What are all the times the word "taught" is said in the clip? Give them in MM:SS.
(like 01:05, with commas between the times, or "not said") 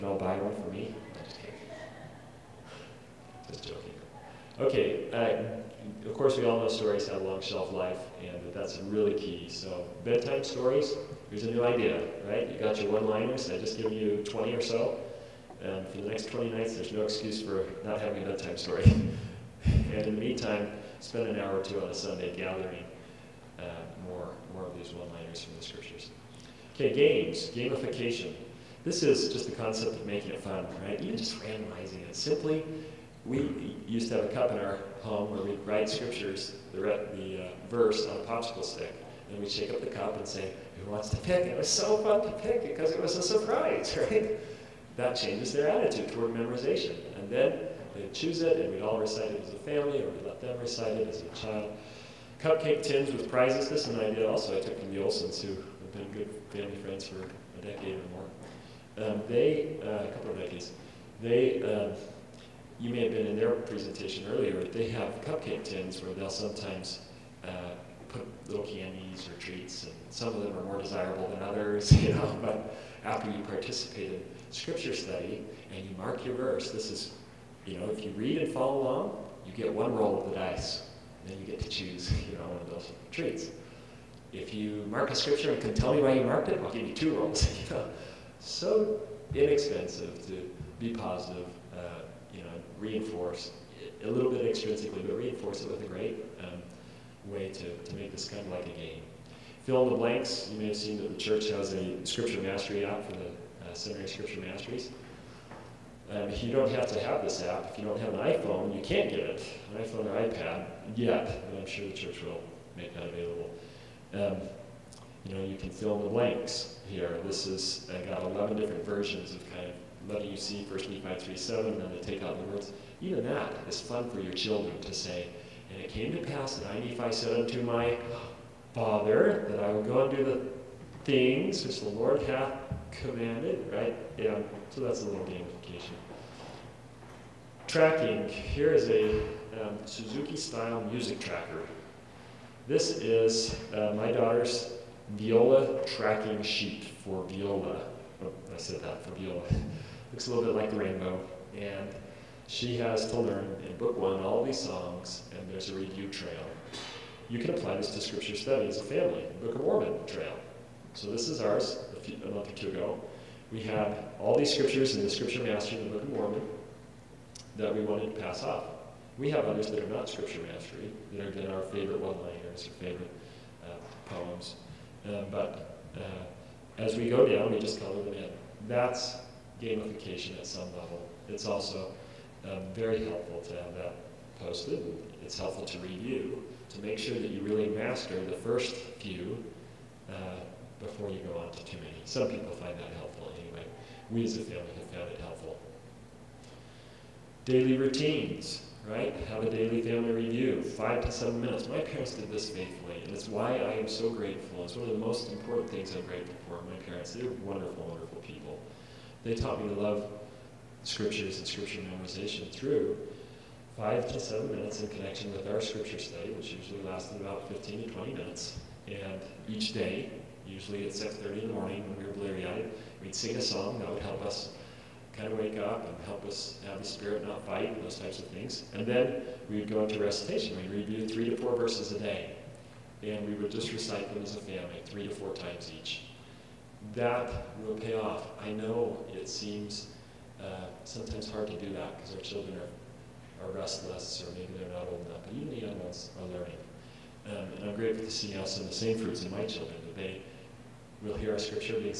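03:29.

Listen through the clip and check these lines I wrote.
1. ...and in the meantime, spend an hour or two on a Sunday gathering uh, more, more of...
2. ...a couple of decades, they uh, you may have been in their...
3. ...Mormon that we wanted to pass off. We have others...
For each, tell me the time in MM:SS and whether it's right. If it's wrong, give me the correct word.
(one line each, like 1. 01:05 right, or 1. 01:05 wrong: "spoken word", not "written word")
1. 00:19 right
2. 01:00 right
3. 02:46 right.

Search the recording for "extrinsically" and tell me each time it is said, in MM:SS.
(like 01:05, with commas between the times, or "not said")
01:34.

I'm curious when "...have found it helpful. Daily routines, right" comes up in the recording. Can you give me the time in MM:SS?
03:14.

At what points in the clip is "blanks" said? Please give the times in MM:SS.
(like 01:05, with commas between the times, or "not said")
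01:39, 01:56.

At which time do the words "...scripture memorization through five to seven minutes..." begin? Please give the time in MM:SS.
03:31.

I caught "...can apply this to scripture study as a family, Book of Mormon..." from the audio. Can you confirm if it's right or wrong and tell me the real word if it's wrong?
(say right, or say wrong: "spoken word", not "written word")
right.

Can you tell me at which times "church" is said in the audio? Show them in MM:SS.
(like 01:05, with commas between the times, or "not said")
01:41, 01:51.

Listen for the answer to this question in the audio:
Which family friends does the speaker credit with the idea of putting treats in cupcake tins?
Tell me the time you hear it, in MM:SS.
00:54.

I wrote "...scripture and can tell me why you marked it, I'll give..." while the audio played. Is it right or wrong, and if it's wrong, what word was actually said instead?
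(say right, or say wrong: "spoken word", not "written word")
right.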